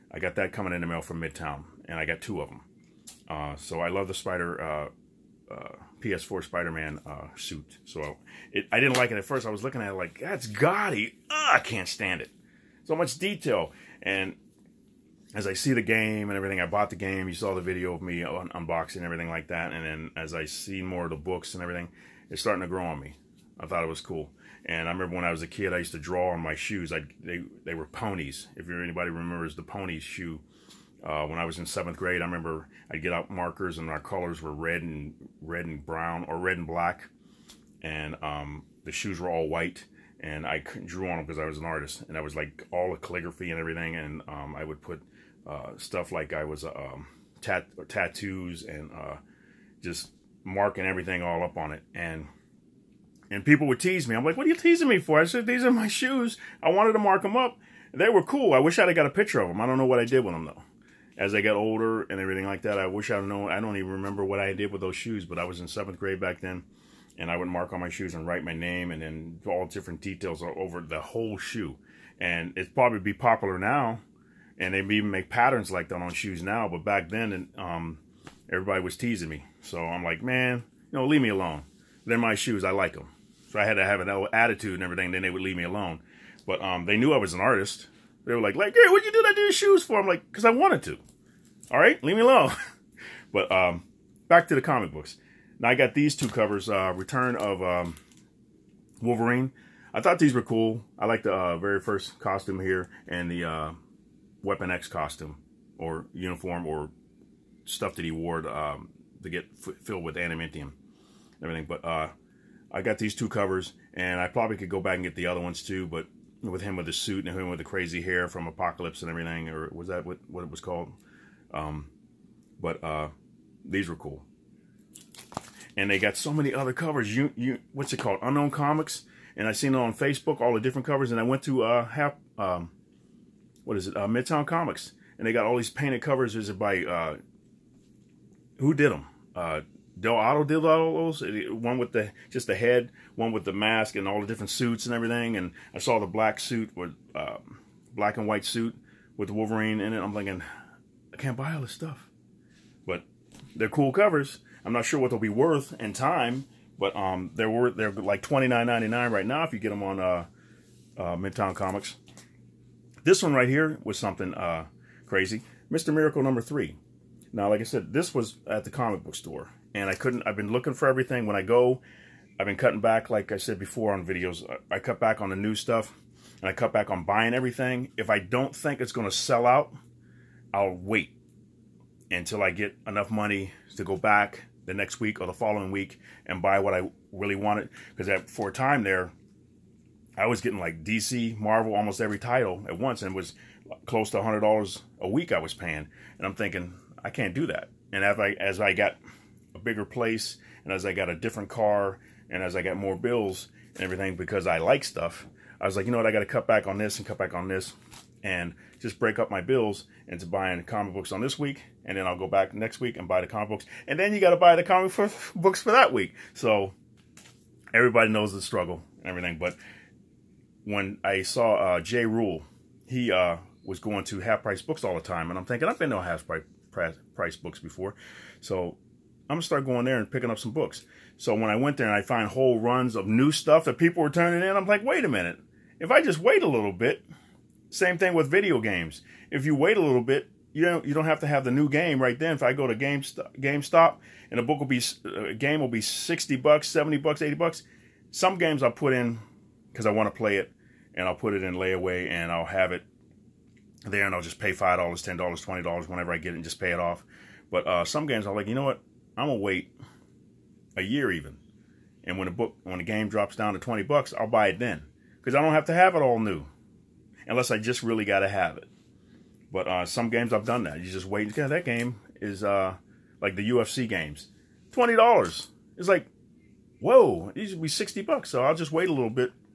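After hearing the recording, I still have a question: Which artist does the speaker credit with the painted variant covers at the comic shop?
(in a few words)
Dell'Otto.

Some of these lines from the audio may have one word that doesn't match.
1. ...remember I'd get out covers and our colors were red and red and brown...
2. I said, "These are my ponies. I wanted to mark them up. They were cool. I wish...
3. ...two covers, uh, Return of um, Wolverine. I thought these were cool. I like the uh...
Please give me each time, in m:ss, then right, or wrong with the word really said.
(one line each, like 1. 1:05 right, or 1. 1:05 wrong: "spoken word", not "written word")
1. 0:32 wrong: "markers", not "covers"
2. 0:55 wrong: "shoes", not "ponies"
3. 1:36 right.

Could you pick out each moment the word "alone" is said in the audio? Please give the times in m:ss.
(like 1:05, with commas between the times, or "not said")
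1:21, 1:25, 1:32.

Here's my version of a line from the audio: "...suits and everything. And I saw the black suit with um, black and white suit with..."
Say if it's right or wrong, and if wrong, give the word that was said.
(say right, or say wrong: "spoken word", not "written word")
right.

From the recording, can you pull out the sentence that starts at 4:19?
I'm gonna wait a year even.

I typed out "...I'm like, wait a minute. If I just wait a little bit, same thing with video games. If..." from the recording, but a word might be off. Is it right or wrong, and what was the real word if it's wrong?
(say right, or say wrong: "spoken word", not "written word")
right.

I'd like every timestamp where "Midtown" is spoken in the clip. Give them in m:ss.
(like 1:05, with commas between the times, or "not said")
0:01, 2:14, 2:41.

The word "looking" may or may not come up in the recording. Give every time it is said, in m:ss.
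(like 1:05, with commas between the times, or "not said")
0:09, 2:50.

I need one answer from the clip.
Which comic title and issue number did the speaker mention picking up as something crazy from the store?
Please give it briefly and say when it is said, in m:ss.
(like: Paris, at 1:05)
Mr. Miracle #3, at 2:45.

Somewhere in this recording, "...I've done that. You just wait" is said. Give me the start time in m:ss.
4:30.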